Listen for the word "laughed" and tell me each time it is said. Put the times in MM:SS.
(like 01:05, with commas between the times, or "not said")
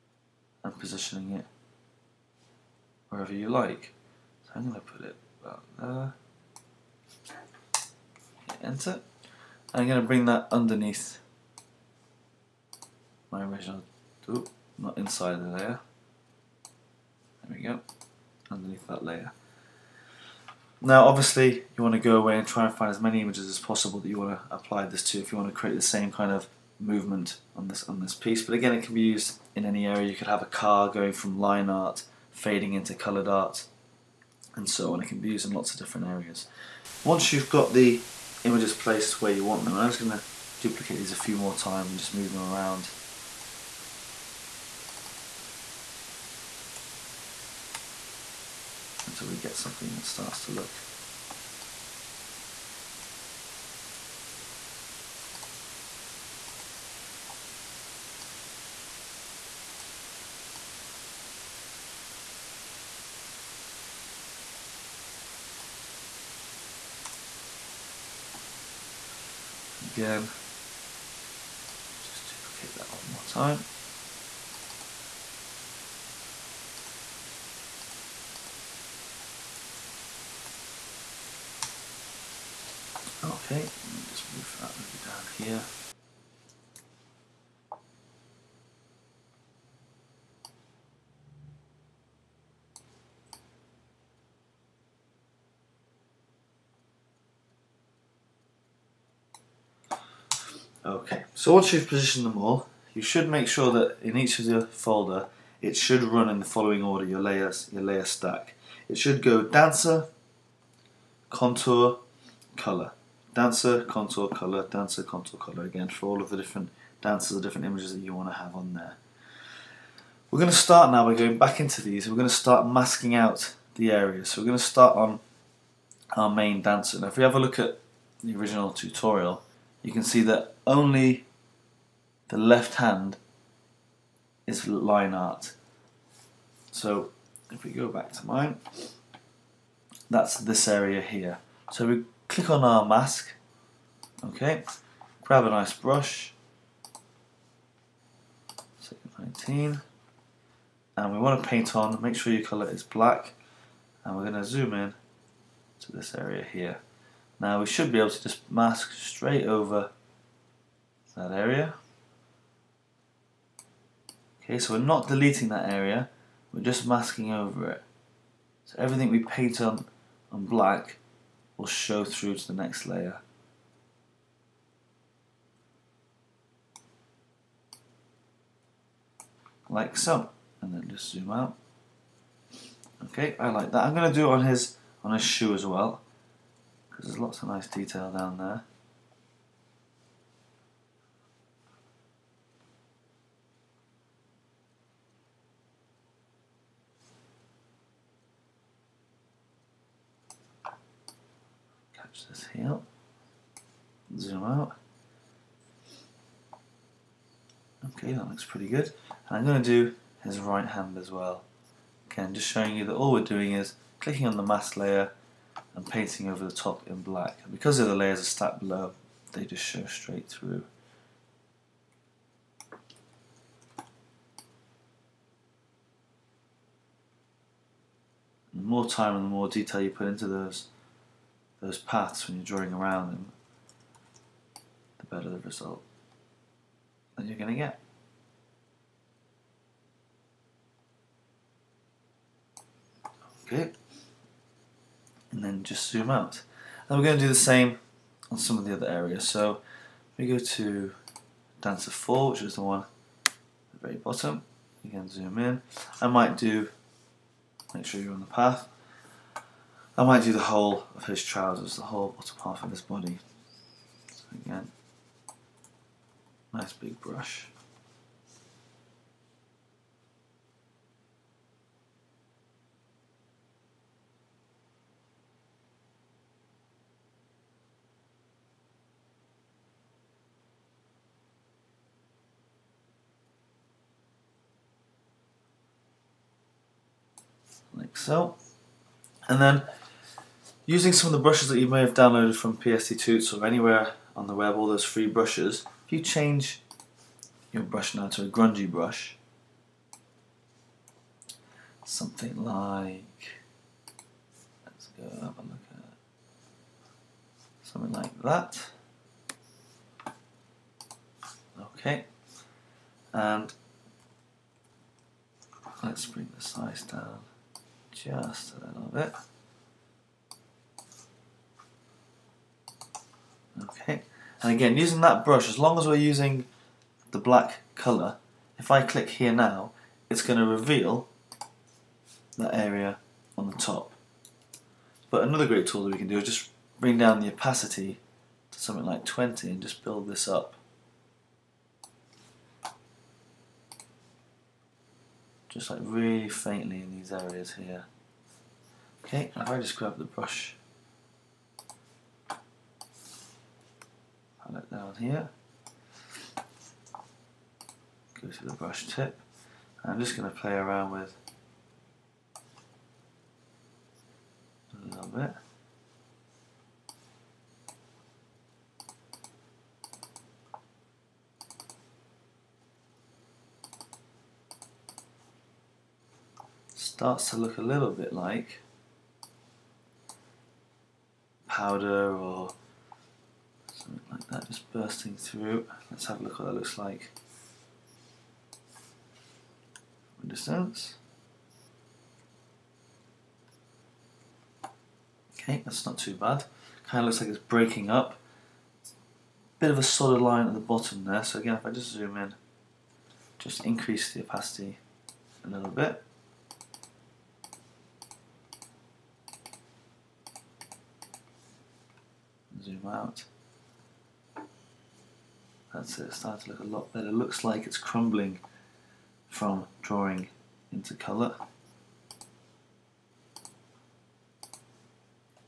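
not said.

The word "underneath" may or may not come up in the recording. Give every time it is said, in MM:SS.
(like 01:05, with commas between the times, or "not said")
00:10, 00:18.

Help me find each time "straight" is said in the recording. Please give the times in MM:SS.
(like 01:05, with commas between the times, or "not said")
02:38, 03:39.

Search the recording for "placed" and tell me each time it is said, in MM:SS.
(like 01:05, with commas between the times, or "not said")
00:38.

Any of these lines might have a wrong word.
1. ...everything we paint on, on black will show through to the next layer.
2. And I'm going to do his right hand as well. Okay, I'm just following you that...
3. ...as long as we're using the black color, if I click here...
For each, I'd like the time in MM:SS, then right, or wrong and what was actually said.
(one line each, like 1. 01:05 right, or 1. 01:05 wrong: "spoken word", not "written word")
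1. 02:48 right
2. 03:29 wrong: "showing", not "following"
3. 05:25 right.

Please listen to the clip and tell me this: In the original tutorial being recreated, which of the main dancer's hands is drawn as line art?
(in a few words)
The left hand.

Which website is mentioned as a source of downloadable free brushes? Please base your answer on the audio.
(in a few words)
PSDTUTS.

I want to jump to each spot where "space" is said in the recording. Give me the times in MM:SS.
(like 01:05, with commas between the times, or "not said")
not said.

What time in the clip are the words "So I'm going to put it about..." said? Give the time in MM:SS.
00:04.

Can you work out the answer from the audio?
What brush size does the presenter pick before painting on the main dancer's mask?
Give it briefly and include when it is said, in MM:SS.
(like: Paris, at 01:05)
19, at 02:29.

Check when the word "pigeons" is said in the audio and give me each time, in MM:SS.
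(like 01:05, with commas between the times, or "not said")
not said.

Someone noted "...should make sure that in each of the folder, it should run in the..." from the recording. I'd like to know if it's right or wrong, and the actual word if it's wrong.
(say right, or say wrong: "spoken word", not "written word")
right.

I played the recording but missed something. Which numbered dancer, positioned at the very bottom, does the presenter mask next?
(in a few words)
Dancer 4.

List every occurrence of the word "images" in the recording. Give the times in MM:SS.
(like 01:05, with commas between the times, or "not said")
00:23, 00:38, 01:57.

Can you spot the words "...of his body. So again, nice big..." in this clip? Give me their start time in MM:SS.
04:22.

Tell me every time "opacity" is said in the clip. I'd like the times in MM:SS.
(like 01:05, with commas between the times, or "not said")
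05:37, 06:44.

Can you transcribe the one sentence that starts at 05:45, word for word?
Just like really faintly in these areas here.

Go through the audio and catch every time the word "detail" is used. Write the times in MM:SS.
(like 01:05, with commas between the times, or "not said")
03:07, 03:49.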